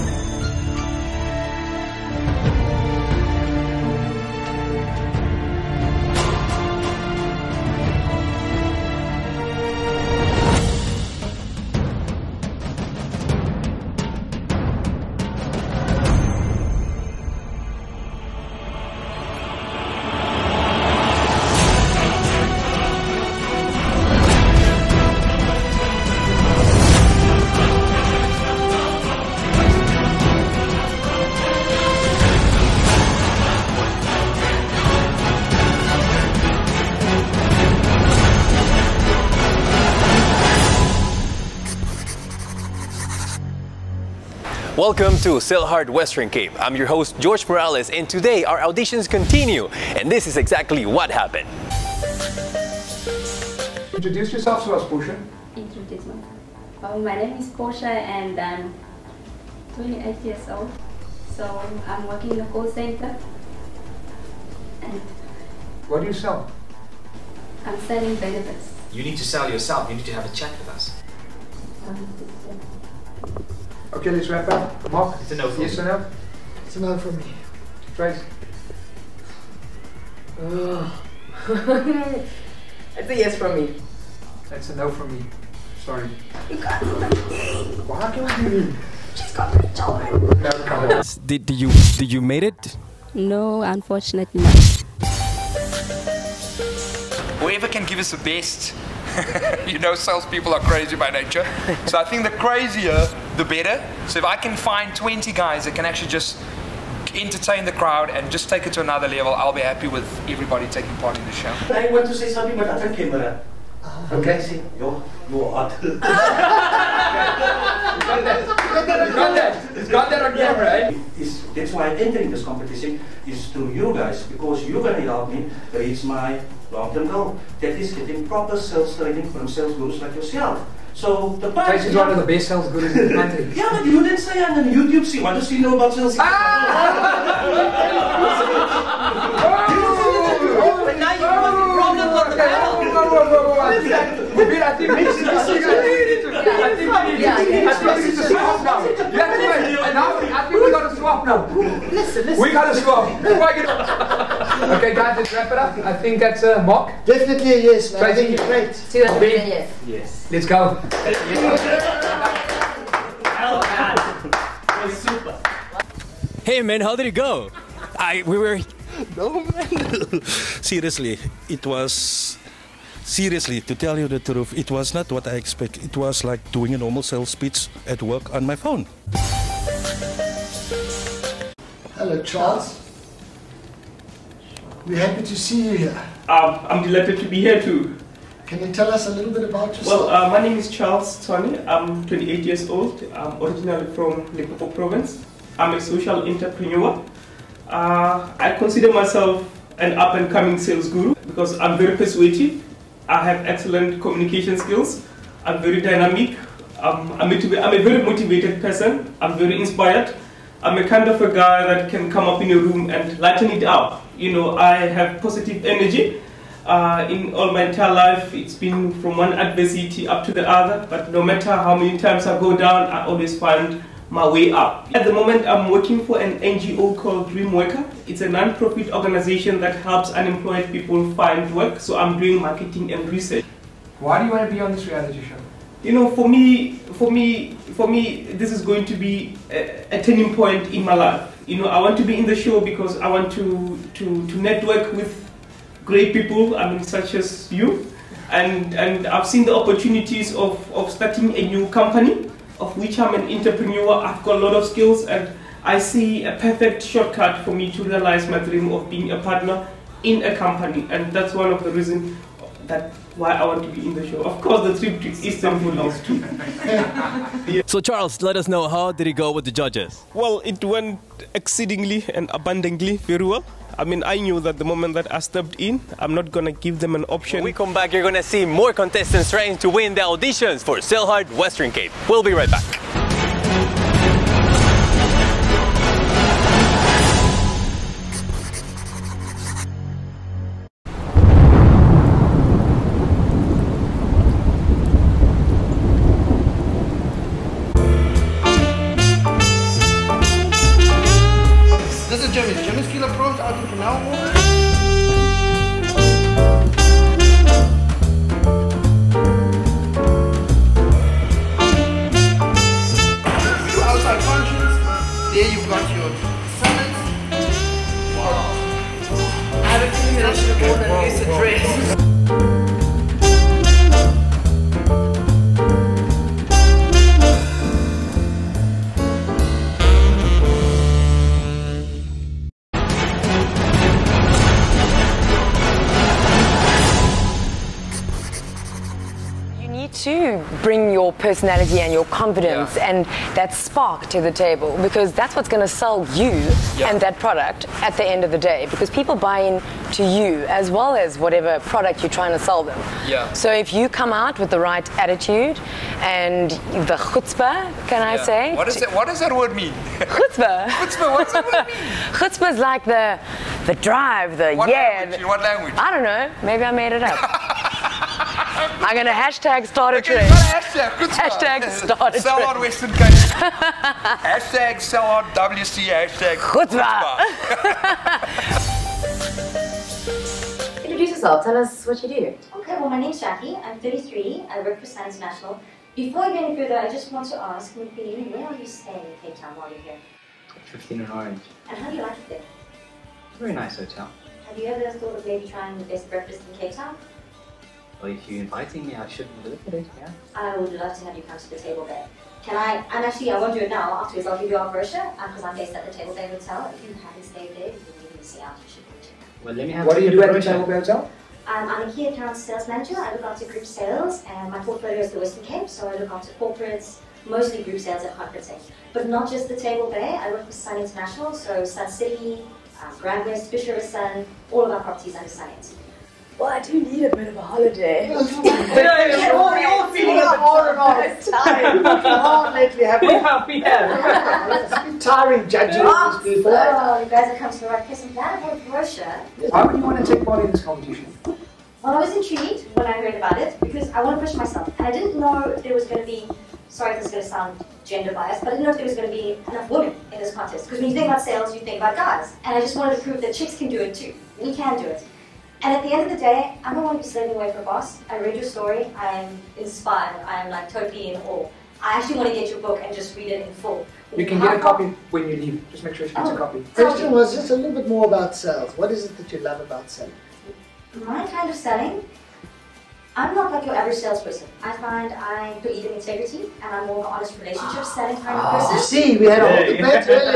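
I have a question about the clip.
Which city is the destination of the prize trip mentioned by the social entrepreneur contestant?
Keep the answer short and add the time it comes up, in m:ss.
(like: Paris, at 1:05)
Istanbul, at 4:25.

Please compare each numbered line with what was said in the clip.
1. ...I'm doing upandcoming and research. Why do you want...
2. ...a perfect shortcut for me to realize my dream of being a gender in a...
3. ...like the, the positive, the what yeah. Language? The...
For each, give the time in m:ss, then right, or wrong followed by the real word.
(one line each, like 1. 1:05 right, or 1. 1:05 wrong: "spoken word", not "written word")
1. 3:51 wrong: "marketing", not "upandcoming"
2. 4:16 wrong: "partner", not "gender"
3. 6:02 wrong: "drive", not "positive".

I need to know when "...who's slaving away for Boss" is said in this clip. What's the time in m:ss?
7:36.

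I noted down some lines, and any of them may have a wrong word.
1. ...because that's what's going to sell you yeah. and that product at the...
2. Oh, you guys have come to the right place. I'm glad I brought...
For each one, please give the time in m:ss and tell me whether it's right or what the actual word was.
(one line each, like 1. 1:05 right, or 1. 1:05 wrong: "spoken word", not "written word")
1. 5:44 right
2. 7:16 right.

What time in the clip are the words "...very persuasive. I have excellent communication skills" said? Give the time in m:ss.
3:21.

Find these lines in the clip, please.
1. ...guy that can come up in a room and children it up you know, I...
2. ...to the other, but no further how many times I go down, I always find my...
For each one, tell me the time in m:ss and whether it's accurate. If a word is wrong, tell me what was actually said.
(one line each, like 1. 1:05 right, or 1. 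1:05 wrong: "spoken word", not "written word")
1. 3:31 wrong: "lighten", not "children"
2. 3:40 wrong: "matter", not "further".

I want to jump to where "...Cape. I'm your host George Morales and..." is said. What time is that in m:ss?
0:46.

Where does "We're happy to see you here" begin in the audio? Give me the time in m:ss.
3:04.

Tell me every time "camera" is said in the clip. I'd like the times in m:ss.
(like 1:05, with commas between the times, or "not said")
1:52, 2:00.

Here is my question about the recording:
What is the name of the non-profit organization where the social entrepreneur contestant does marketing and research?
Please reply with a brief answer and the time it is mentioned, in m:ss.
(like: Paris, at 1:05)
Dream Worker, at 3:47.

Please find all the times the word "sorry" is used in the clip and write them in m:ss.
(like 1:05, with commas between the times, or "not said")
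1:25, 7:26.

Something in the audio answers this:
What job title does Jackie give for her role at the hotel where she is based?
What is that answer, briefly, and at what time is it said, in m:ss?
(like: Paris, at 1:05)
key account sales manager, at 6:51.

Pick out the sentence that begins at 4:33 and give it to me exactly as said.
I mean, I knew that the moment that I stepped in, I'm not gonna give them an option.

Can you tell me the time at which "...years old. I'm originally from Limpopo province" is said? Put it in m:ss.
3:12.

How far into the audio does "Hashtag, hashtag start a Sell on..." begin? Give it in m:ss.
6:10.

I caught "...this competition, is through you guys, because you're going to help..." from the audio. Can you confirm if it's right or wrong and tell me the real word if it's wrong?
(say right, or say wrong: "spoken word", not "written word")
right.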